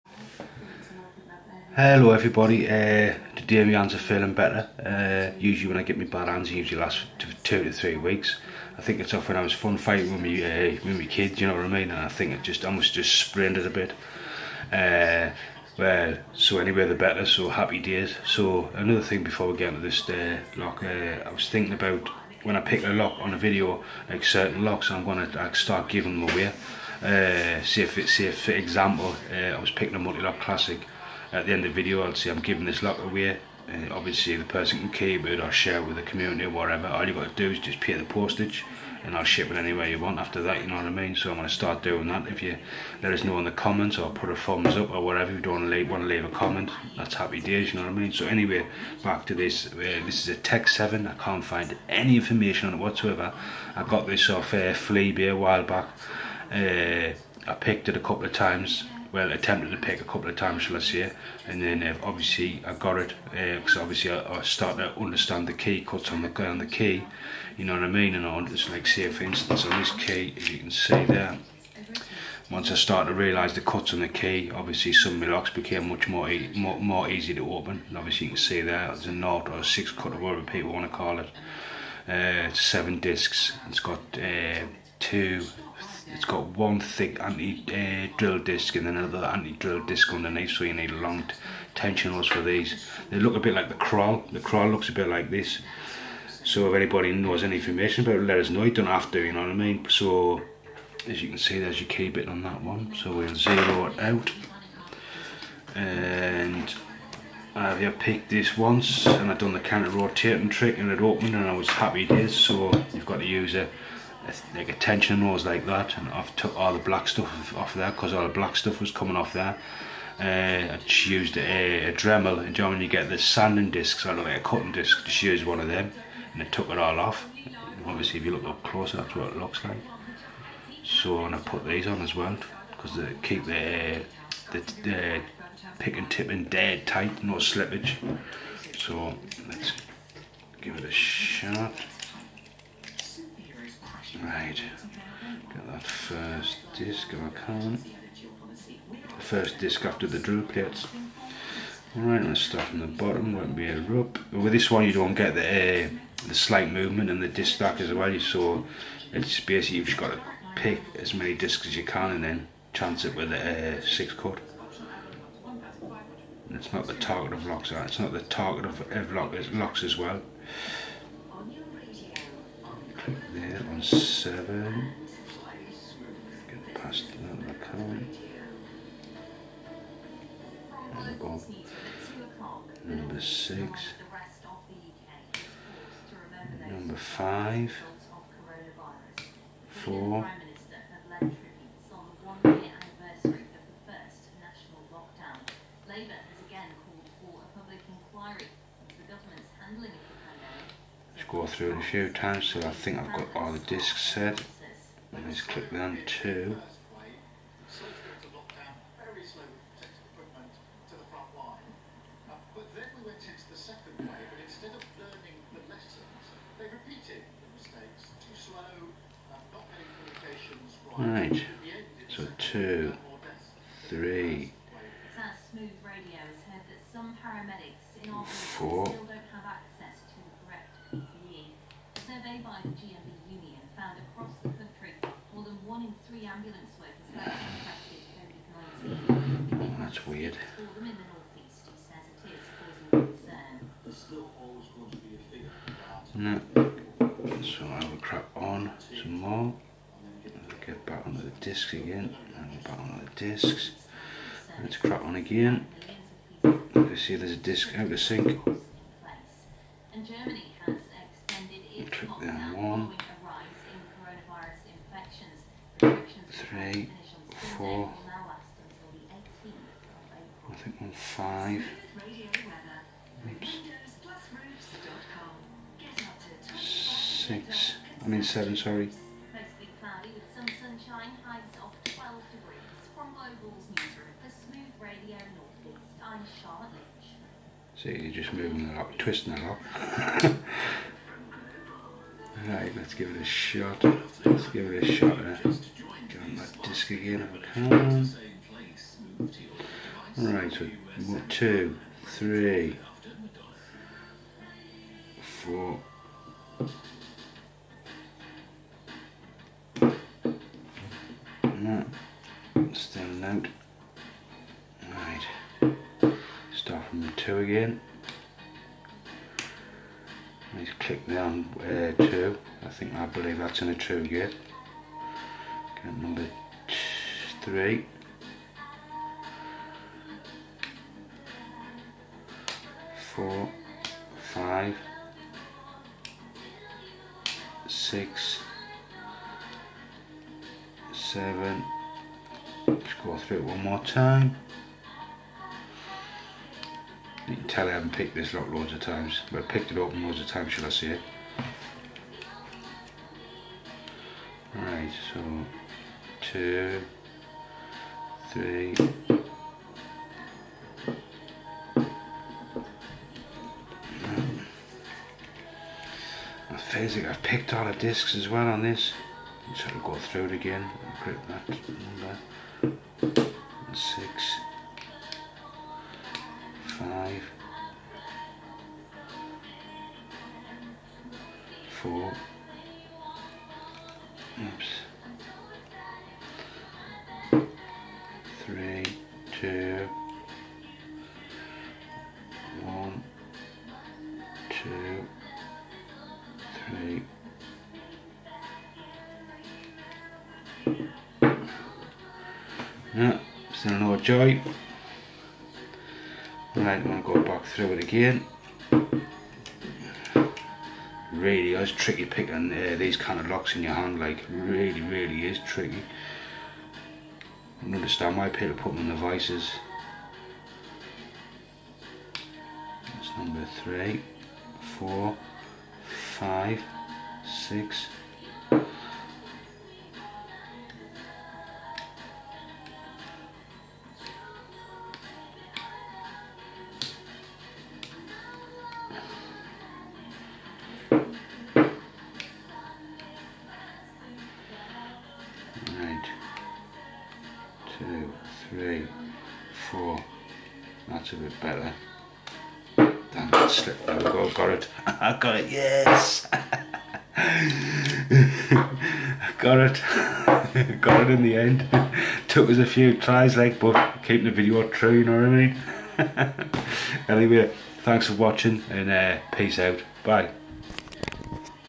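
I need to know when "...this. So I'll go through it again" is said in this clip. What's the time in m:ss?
6:08.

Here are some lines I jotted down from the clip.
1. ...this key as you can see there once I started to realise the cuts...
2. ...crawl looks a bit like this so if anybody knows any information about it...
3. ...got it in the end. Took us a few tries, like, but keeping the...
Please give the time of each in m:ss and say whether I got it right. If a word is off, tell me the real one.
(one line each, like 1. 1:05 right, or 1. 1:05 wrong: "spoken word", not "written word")
1. 1:09 right
2. 1:34 right
3. 7:40 right.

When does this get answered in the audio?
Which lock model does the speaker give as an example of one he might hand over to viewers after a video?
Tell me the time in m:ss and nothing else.
0:29.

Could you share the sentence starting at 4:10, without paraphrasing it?
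Get back onto the discs again.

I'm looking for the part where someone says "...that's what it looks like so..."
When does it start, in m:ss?
2:08.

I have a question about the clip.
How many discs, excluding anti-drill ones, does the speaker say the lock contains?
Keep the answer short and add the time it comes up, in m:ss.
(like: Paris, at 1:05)
7, at 1:22.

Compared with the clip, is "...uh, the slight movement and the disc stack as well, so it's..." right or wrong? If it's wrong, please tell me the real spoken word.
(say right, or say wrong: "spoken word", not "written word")
right.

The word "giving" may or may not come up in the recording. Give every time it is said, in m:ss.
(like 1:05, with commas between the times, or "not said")
0:25, 0:32.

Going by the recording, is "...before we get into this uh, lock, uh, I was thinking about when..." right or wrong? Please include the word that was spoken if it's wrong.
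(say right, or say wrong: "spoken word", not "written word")
right.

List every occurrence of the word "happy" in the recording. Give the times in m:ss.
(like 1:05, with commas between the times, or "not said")
0:17, 0:47, 1:51.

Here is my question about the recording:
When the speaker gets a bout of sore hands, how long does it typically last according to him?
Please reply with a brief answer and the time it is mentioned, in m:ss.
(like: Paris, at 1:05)
2 to 3 weeks, at 0:07.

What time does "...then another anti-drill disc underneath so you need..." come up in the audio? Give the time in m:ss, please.
1:28.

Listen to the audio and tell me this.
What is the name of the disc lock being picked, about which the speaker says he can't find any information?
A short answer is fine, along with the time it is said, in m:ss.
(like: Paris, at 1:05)
Tech 7, at 0:50.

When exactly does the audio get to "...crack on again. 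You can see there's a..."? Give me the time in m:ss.
4:14.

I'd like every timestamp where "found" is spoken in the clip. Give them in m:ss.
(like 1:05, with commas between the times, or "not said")
3:53.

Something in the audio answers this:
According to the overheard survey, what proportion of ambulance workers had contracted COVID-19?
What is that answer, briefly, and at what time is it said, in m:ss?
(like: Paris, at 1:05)
more than 1 in 3, at 3:55.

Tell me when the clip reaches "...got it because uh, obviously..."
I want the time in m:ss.
1:02.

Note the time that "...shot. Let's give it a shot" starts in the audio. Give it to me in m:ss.
4:53.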